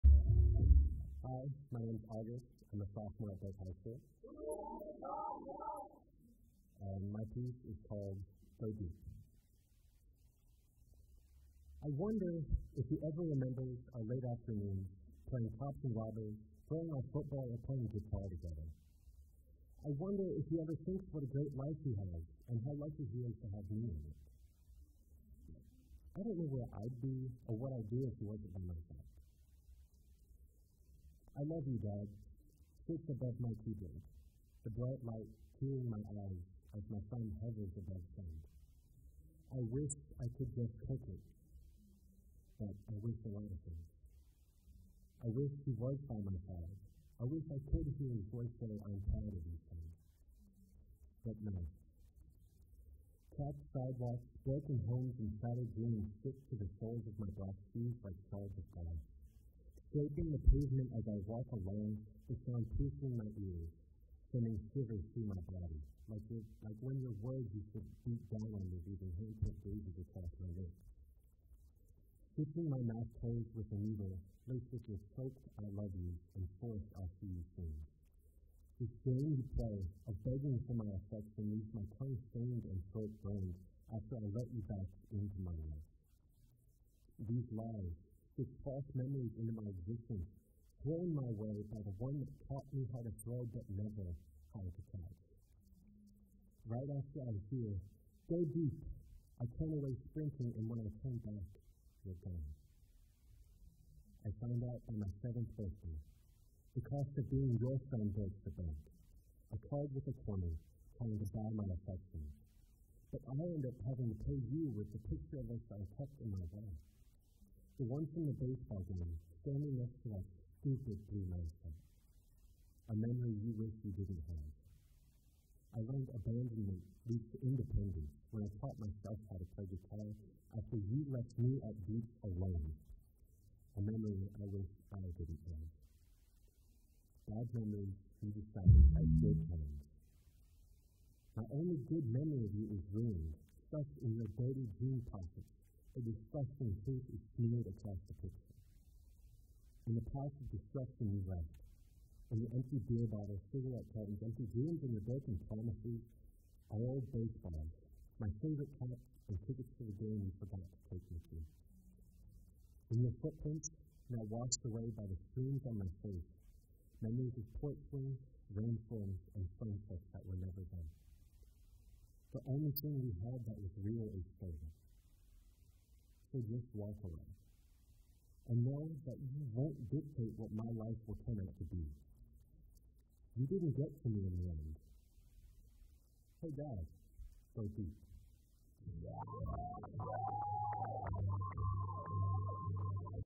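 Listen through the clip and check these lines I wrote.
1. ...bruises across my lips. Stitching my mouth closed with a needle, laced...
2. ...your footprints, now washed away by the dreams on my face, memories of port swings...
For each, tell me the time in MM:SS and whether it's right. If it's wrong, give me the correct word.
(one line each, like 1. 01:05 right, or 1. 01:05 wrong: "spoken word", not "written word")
1. 01:09 right
2. 02:43 wrong: "streams", not "dreams".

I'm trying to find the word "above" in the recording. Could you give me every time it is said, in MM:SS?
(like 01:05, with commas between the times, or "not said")
00:33, 00:37.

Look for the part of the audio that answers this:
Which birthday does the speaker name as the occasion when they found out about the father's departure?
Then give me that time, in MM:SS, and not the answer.
01:45.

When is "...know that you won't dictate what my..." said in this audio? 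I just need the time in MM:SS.
02:58.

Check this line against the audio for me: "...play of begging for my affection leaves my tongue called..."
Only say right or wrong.
wrong.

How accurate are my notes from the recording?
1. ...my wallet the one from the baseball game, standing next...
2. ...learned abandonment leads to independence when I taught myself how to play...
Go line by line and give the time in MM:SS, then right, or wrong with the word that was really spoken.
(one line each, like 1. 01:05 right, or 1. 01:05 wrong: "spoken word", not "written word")
1. 01:56 right
2. 02:05 right.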